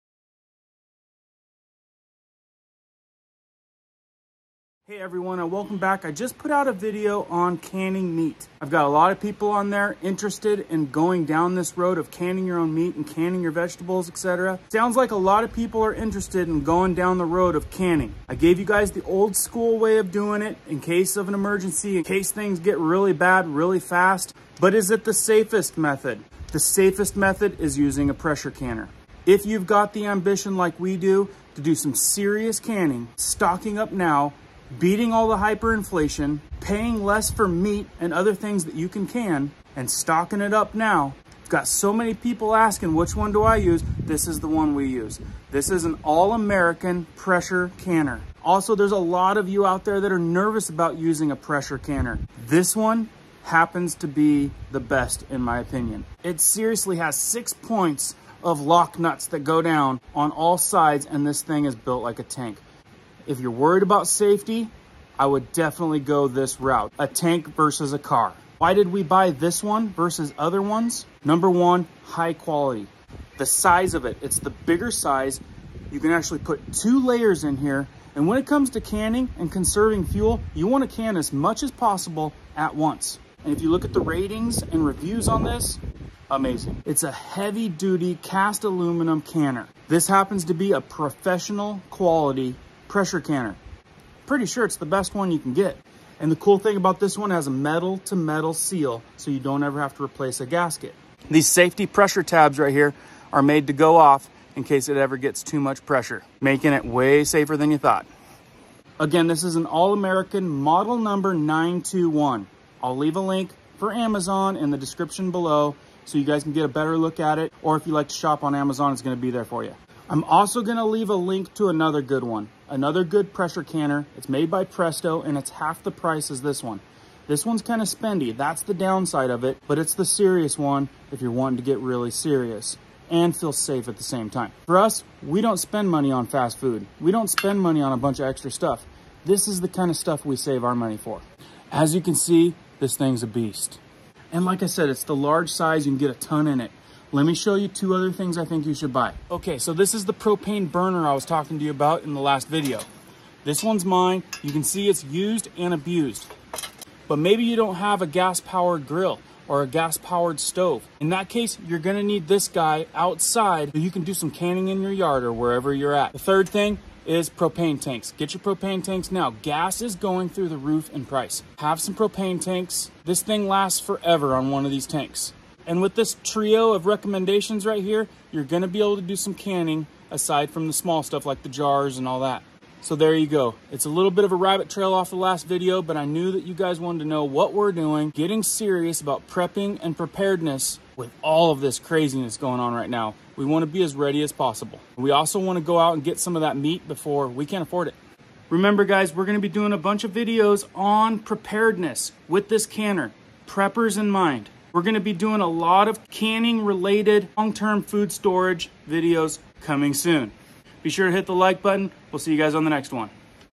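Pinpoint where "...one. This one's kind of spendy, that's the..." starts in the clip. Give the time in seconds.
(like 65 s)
126 s.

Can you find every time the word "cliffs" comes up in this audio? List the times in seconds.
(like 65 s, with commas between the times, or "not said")
not said.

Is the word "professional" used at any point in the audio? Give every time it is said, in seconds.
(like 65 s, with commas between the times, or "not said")
90 s.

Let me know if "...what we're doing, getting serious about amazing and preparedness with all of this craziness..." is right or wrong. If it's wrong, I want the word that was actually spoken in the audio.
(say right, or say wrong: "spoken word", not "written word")
wrong: "prepping", not "amazing".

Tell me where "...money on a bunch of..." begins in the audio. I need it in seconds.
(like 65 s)
137 s.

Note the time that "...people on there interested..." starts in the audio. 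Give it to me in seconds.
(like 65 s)
9 s.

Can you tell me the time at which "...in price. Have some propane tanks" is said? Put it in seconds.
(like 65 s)
170 s.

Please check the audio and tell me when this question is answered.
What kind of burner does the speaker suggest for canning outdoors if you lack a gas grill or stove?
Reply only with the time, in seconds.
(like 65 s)
150 s.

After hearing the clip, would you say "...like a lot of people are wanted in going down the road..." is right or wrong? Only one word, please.
wrong.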